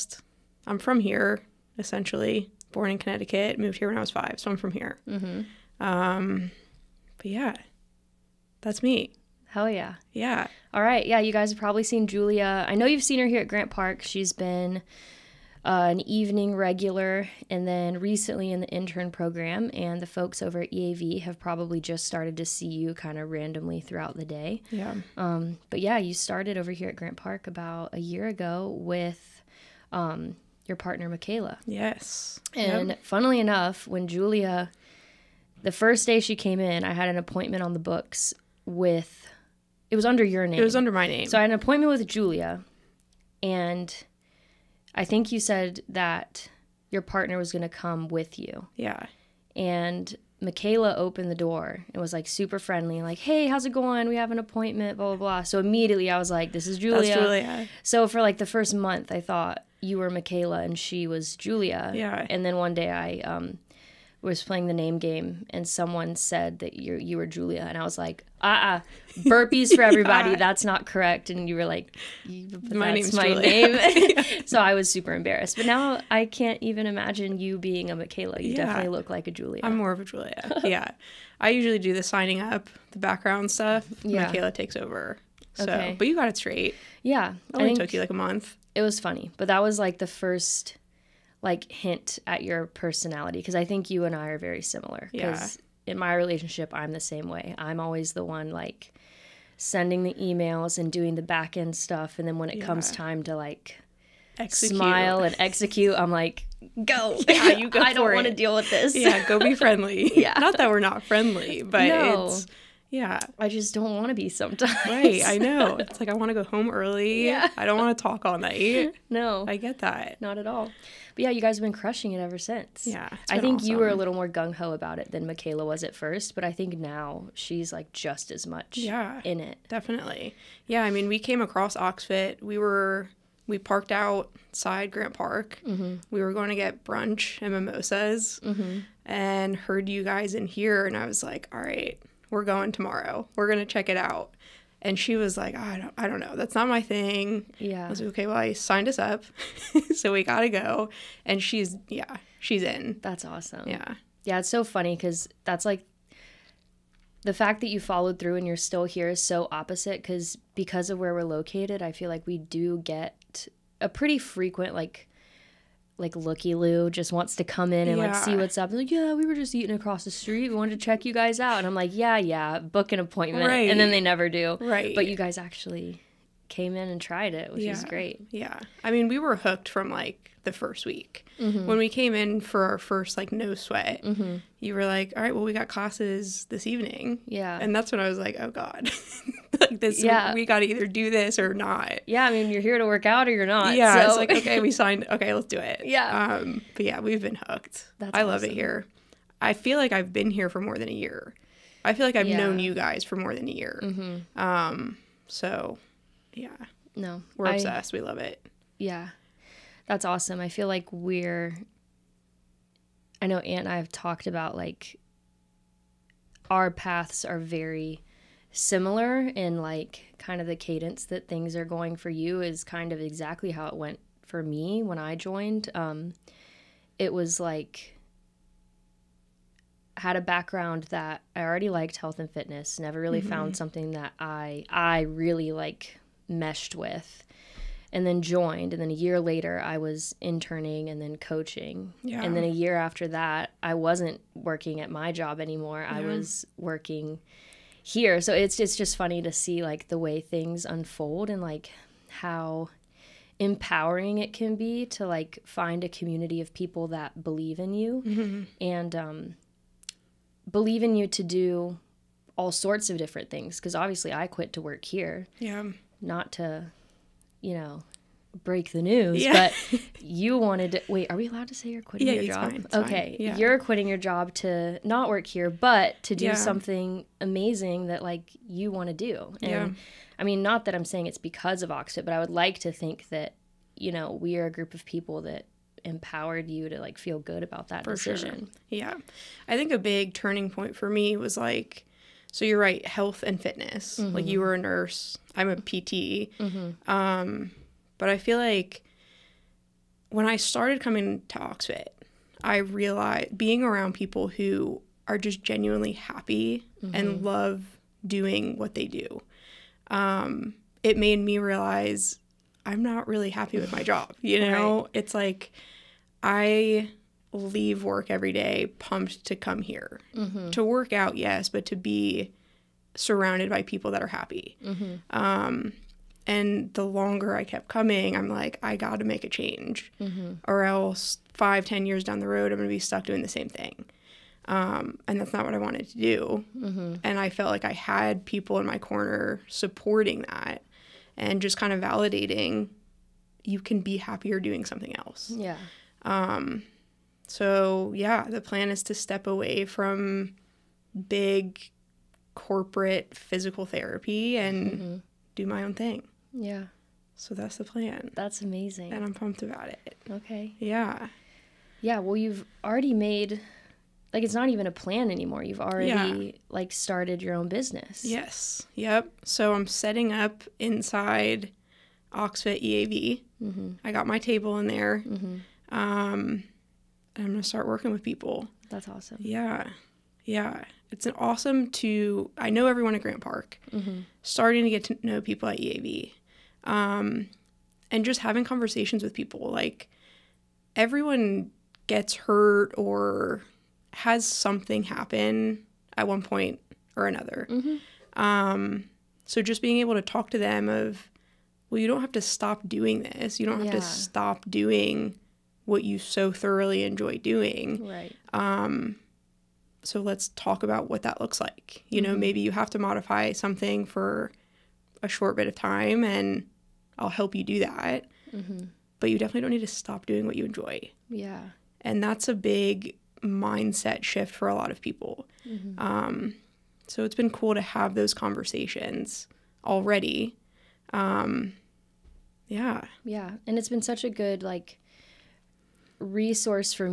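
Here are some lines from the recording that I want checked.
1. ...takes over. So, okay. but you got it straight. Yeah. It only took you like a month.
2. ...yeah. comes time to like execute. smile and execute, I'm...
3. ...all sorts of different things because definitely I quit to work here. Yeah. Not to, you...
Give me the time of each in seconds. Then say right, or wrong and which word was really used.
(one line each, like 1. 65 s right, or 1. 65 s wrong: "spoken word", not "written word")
1. 84 s right
2. 102 s right
3. 262 s wrong: "obviously", not "definitely".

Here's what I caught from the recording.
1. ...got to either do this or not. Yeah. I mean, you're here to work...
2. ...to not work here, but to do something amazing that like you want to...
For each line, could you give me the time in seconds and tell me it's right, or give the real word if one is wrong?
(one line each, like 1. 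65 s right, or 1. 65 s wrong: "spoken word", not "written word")
1. 190 s right
2. 274 s right.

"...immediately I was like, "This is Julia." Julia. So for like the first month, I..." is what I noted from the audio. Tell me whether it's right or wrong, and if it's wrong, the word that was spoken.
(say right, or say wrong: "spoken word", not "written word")
right.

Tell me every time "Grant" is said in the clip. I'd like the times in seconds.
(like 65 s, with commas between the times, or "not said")
13 s, 26 s, 134 s, 383 s.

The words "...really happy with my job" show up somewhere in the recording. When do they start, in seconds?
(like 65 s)
313 s.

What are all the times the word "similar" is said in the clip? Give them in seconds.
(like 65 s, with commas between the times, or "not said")
94 s, 218 s.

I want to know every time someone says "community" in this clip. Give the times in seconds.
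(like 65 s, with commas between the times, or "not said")
255 s.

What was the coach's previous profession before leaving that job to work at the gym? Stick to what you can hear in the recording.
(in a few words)
Nurse.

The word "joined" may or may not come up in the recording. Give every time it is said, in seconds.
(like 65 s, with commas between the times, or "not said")
225 s, 238 s.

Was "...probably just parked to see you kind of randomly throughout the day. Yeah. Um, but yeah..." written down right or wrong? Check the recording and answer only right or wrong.
wrong.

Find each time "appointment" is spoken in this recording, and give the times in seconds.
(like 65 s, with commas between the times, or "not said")
37 s, 41 s, 54 s, 172 s.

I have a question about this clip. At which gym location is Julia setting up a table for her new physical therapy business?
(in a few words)
Oxfit EAV.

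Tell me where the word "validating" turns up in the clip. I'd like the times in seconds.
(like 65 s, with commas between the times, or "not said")
341 s.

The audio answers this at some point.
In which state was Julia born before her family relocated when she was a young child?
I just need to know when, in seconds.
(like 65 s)
2 s.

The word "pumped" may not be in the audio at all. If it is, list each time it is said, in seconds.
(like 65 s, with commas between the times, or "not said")
318 s, 359 s.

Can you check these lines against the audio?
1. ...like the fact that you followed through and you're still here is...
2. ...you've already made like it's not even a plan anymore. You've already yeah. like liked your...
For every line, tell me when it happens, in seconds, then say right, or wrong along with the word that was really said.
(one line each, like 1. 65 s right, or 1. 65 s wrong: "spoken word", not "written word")
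1. 155 s right
2. 362 s wrong: "started", not "liked".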